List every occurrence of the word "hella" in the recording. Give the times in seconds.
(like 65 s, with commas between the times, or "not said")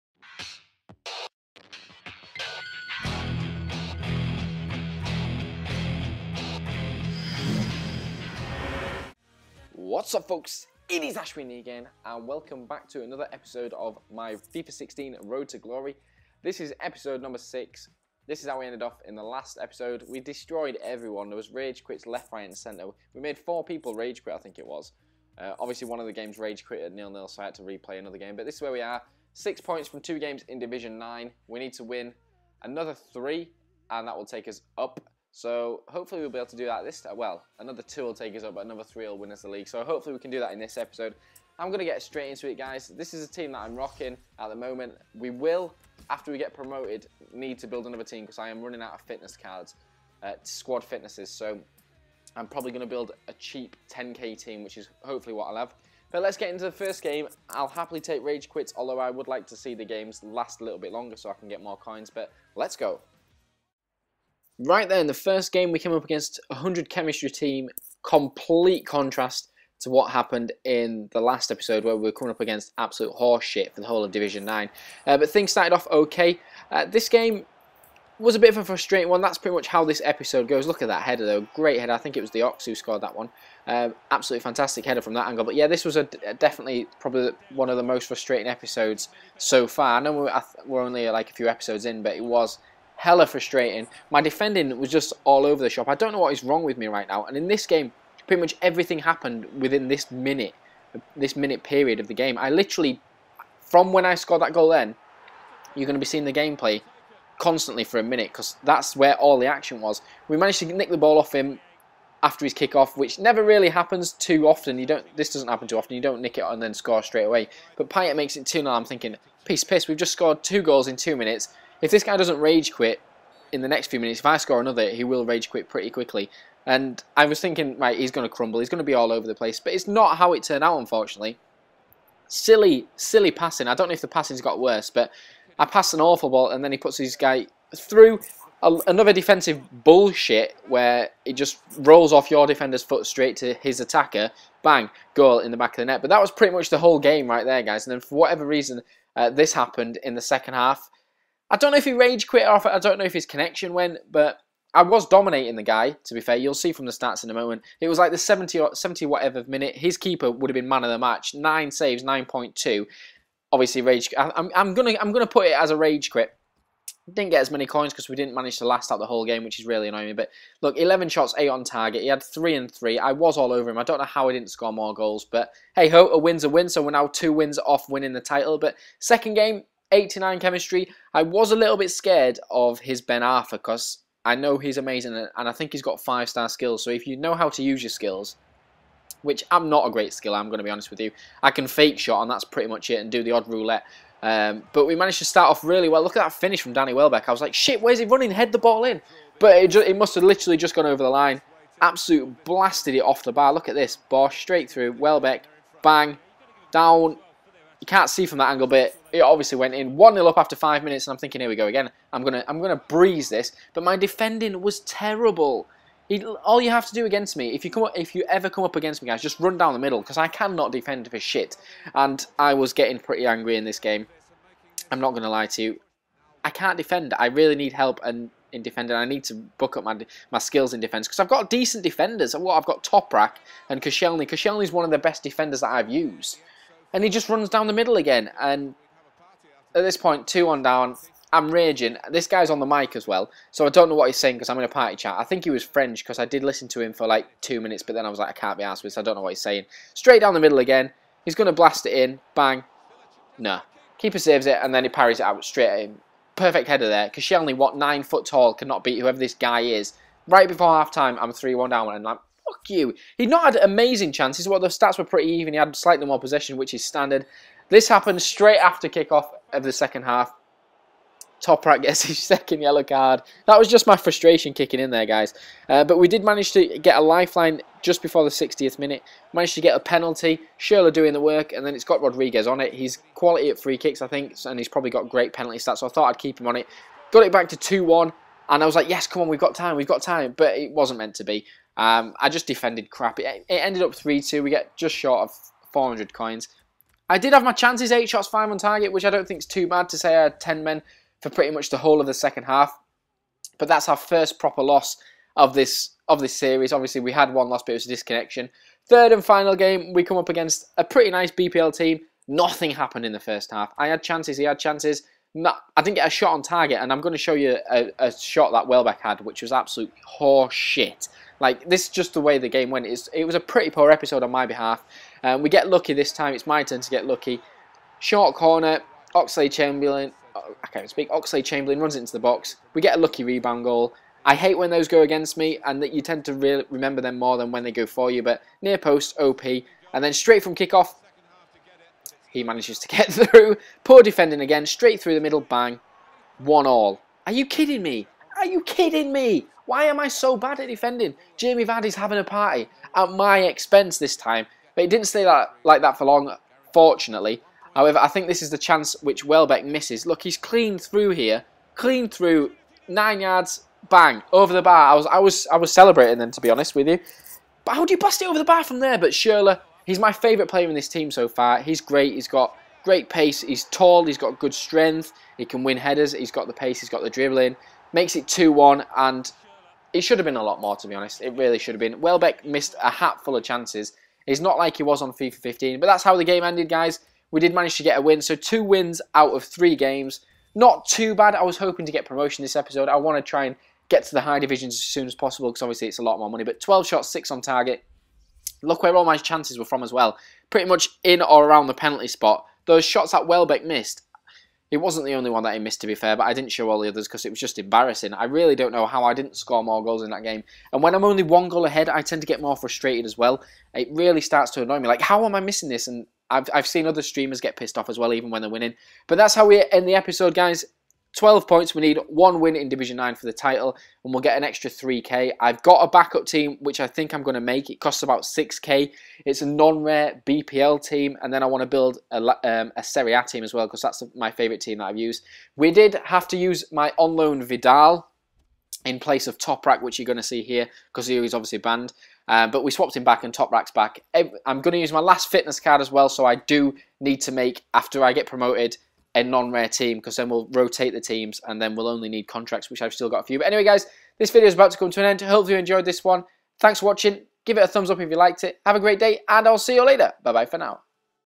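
93 s.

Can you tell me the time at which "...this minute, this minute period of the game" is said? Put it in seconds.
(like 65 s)
99 s.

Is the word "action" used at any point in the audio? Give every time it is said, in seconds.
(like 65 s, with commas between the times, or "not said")
109 s.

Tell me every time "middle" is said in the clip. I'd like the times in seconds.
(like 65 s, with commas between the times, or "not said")
219 s, 237 s, 250 s, 345 s.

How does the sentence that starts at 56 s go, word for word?
But let's get into the first game.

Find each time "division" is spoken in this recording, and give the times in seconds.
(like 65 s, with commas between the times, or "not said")
30 s, 74 s, 394 s, 422 s.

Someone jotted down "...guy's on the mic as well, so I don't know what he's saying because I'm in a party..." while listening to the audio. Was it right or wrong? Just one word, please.
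right.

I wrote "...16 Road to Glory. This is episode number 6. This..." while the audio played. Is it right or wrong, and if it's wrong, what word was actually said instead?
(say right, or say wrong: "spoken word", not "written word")
right.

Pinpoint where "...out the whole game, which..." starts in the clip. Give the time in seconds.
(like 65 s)
168 s.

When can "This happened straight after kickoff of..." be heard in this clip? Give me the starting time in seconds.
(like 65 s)
267 s.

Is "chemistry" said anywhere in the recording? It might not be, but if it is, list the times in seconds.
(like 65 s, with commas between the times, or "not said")
66 s, 180 s.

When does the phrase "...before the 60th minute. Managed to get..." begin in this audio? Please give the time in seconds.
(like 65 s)
278 s.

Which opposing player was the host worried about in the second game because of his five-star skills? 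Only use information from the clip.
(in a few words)
Ben Arfa.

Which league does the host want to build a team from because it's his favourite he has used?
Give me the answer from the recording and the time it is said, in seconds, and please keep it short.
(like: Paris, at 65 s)
Serie A, at 432 s.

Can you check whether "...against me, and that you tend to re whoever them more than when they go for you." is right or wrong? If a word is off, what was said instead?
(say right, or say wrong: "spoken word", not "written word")
wrong: "remember", not "whoever".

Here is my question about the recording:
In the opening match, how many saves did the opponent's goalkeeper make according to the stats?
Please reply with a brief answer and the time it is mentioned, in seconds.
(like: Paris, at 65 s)
9, at 161 s.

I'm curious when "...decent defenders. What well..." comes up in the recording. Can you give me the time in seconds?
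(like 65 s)
231 s.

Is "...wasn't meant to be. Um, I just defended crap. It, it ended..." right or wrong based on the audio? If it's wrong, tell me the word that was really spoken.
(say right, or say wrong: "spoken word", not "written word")
right.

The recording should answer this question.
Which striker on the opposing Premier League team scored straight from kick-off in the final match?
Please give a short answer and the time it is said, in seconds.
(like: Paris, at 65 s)
Jamie Vardy, at 351 s.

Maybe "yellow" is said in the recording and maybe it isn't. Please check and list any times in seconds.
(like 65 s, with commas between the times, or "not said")
272 s.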